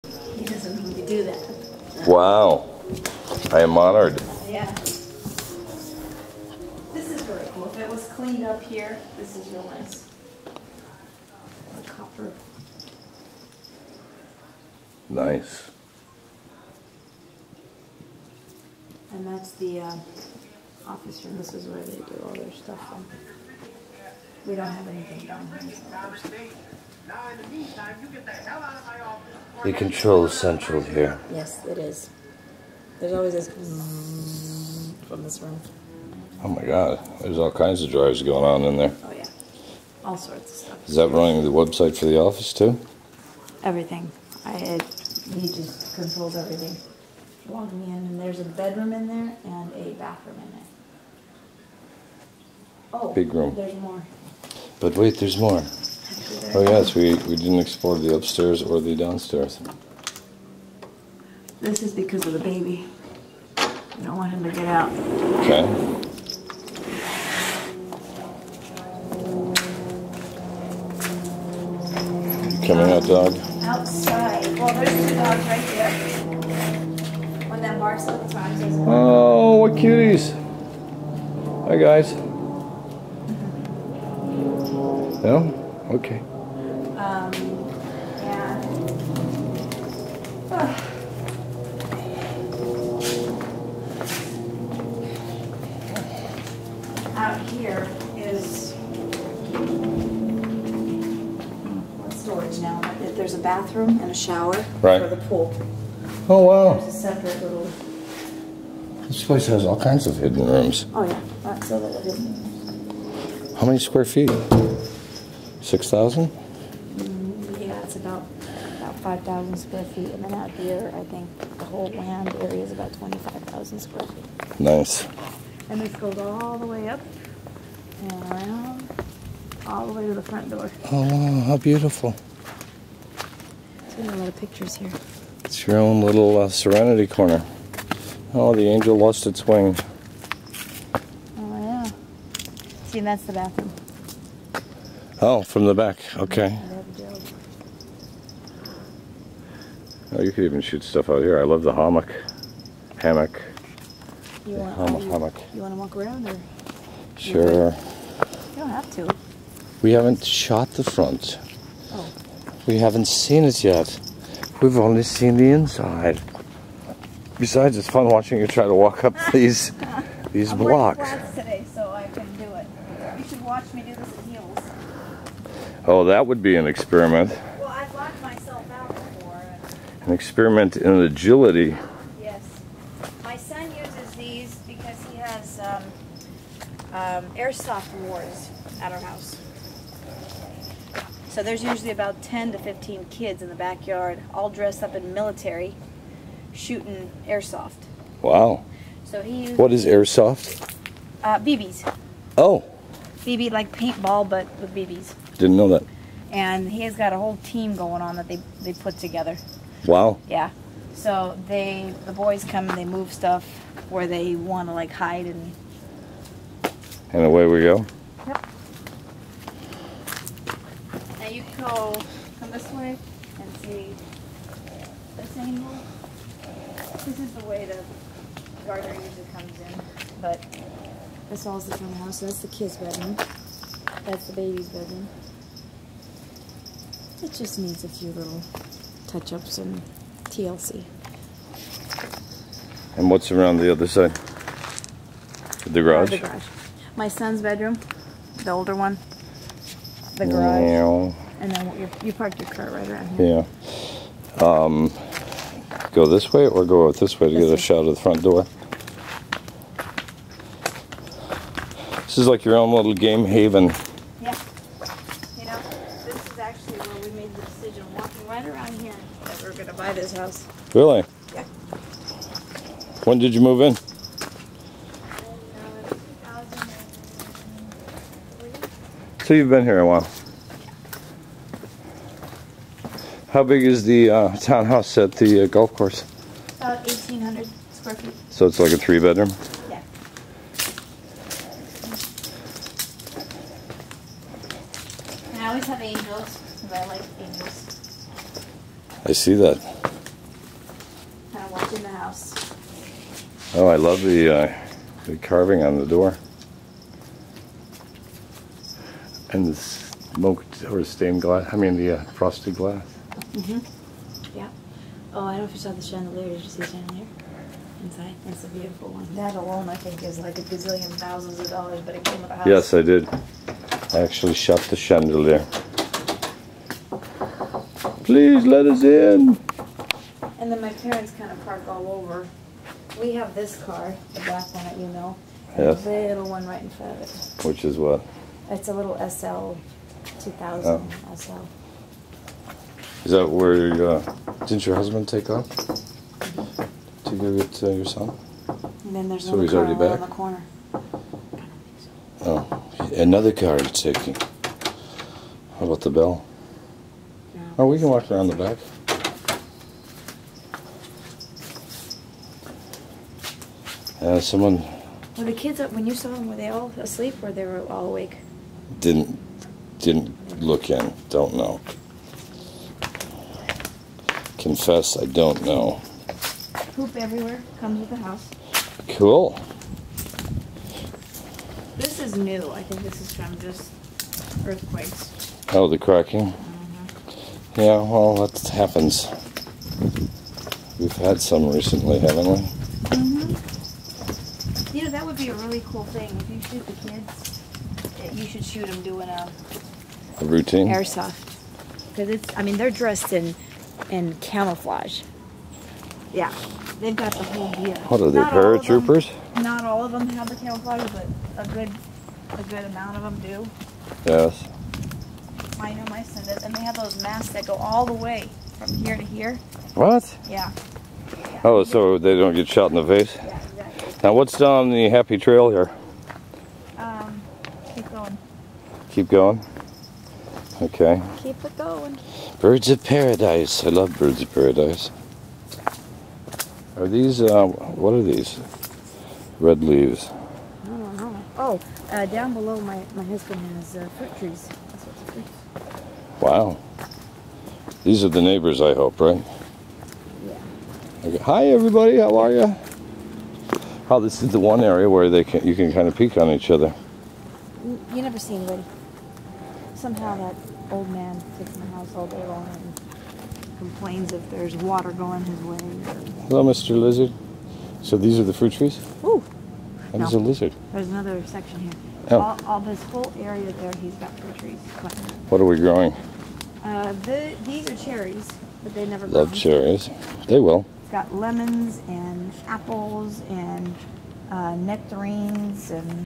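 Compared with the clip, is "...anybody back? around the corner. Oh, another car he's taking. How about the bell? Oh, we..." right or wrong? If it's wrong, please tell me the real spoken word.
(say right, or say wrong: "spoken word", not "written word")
wrong: "already", not "anybody".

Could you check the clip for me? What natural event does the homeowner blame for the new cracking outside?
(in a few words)
Earthquakes.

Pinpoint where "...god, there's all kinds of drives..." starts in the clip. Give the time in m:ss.
0:36.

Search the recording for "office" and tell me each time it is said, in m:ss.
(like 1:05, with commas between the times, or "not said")
0:20, 0:42.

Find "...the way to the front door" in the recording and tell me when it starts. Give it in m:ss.
2:09.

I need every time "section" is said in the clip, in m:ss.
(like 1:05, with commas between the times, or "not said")
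7:51.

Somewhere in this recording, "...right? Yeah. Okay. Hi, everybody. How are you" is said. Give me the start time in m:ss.
7:28.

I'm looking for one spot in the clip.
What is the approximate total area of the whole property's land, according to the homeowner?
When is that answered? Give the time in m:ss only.
2:02.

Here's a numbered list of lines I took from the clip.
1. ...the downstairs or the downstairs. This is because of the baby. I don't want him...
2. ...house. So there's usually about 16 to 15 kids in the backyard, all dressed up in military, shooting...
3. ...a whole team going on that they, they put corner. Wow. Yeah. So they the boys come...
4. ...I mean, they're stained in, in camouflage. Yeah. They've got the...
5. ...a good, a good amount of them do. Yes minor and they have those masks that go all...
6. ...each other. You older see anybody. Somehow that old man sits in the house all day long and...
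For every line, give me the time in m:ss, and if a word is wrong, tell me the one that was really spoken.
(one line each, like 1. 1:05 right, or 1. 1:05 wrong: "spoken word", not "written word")
1. 0:57 wrong: "upstairs", not "downstairs"
2. 3:08 wrong: "10", not "16"
3. 3:27 wrong: "together", not "corner"
4. 6:42 wrong: "dressed", not "stained"
5. 6:51 right
6. 7:36 wrong: "never", not "older".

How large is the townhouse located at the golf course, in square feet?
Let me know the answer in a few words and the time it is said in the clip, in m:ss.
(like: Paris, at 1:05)
1,800 square feet, at 4:46.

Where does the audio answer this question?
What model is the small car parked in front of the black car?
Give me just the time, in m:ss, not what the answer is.
5:39.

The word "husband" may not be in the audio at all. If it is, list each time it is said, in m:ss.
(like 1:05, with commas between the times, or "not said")
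5:44, 7:23.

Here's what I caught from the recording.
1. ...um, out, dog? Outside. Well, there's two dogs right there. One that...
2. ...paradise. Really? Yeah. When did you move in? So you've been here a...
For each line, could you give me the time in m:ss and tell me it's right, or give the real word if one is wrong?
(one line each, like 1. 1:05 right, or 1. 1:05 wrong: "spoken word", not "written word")
1. 1:12 right
2. 4:30 wrong: "house", not "paradise".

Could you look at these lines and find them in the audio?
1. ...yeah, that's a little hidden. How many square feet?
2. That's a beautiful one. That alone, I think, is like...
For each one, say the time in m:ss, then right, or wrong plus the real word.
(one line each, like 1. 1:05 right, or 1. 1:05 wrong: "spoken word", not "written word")
1. 1:51 right
2. 5:18 right.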